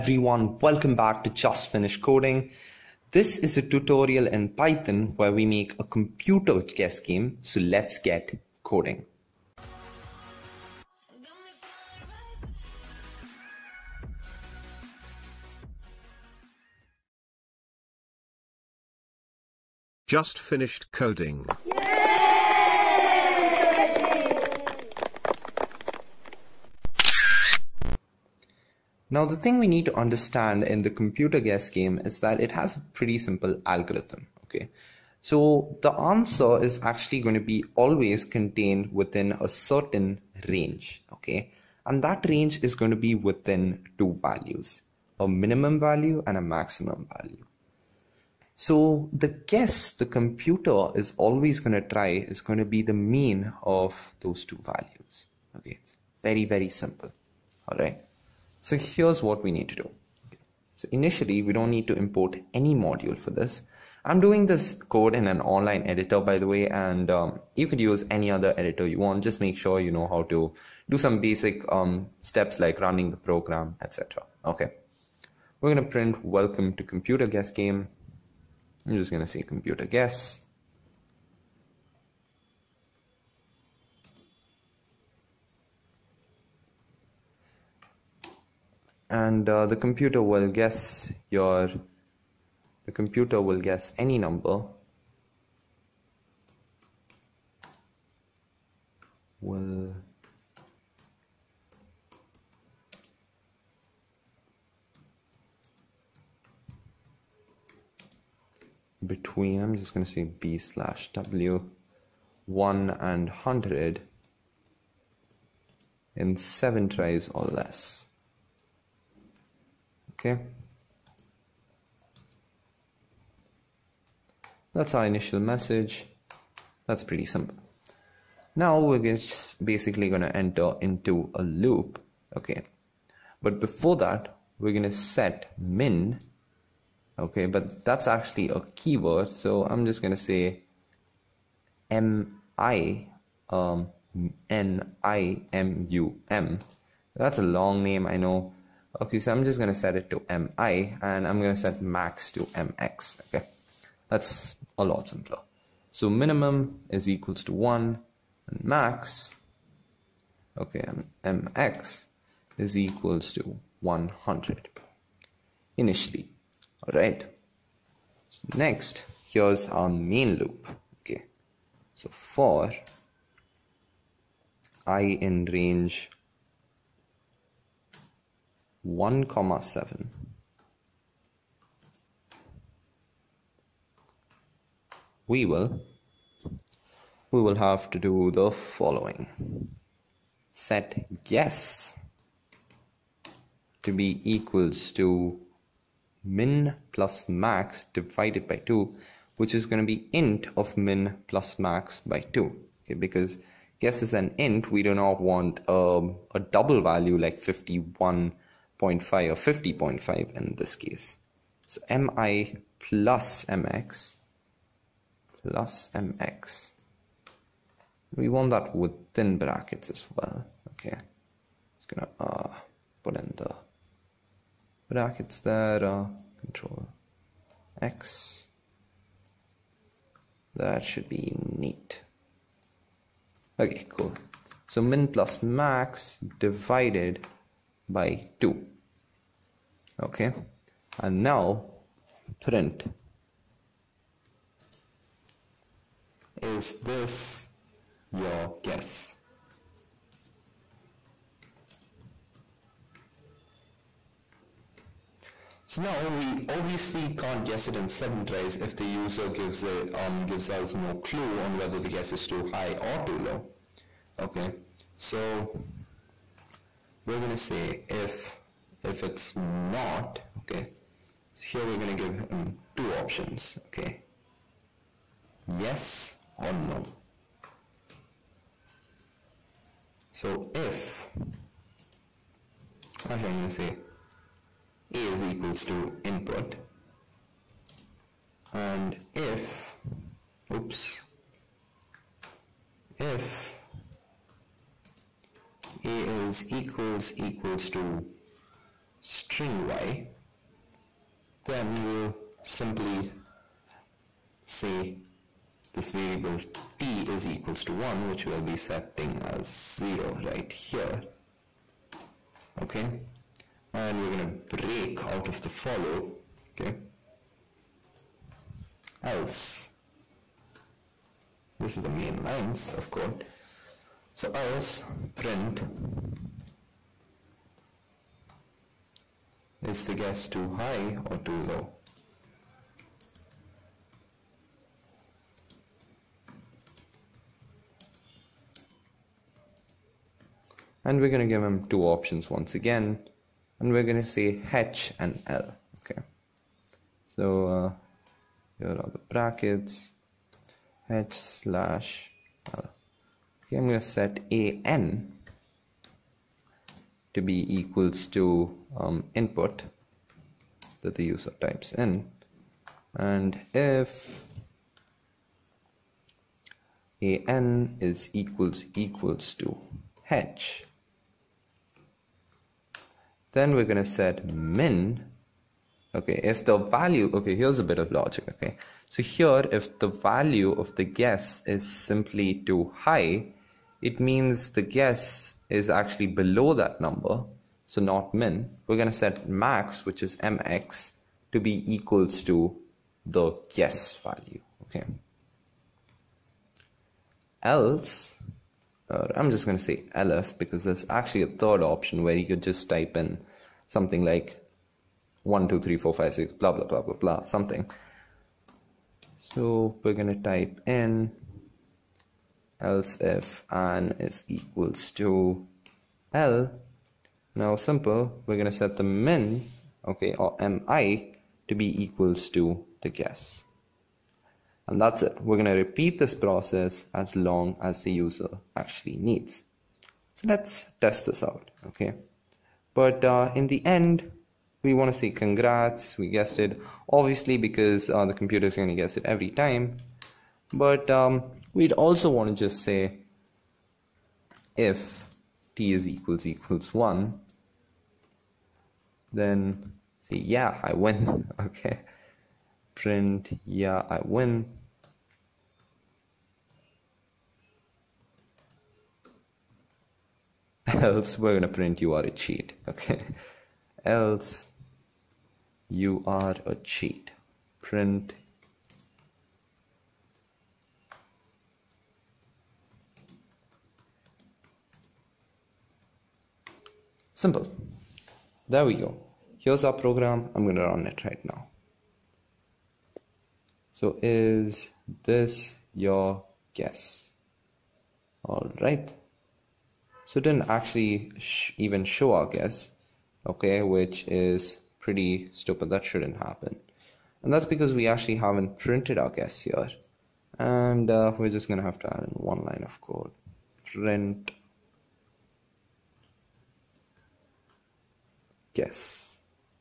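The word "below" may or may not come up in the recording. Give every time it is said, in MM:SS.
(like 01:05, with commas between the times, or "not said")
06:26.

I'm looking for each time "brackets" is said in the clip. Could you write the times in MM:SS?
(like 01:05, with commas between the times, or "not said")
03:39, 03:44, 05:49.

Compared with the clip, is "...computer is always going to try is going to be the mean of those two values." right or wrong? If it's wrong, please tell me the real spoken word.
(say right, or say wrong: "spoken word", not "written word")
right.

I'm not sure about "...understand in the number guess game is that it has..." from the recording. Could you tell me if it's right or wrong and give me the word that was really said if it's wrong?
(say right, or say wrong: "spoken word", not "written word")
wrong: "computer", not "number".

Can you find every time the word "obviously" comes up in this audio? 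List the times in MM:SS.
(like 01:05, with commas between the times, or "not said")
04:16, 07:16.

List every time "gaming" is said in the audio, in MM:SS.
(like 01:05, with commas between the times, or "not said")
not said.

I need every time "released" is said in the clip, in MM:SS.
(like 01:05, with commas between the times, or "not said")
not said.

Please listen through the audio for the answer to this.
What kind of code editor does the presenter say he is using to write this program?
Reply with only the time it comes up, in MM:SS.
01:05.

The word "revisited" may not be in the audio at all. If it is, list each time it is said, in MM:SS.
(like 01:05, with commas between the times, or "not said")
not said.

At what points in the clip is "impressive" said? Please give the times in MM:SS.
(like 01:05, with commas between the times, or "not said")
not said.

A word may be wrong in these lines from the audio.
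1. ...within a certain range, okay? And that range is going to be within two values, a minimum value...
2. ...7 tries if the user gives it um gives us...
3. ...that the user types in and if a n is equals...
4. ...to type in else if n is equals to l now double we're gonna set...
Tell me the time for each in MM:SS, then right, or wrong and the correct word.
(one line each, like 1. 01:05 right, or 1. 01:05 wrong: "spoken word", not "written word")
1. 00:38 right
2. 04:17 right
3. 06:00 right
4. 06:50 wrong: "simple", not "double".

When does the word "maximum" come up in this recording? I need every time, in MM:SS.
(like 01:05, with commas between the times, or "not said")
00:46.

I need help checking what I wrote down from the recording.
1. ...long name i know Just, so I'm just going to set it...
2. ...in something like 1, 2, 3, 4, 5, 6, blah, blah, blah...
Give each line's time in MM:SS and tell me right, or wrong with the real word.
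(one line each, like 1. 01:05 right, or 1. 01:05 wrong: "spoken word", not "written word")
1. 02:27 wrong: "Okay", not "Just"
2. 06:42 right.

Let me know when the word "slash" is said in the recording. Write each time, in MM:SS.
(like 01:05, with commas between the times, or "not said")
01:50, 05:51.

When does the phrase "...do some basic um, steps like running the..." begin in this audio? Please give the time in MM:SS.
01:10.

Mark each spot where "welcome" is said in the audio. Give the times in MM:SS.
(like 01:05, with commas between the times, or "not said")
00:00, 01:16.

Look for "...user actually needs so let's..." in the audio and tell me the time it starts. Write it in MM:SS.
07:07.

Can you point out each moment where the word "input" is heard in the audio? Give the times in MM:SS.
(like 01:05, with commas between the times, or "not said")
04:46, 05:59.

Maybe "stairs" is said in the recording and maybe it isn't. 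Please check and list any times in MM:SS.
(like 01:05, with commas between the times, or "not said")
not said.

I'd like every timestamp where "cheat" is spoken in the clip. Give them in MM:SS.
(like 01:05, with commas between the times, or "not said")
07:42, 07:46.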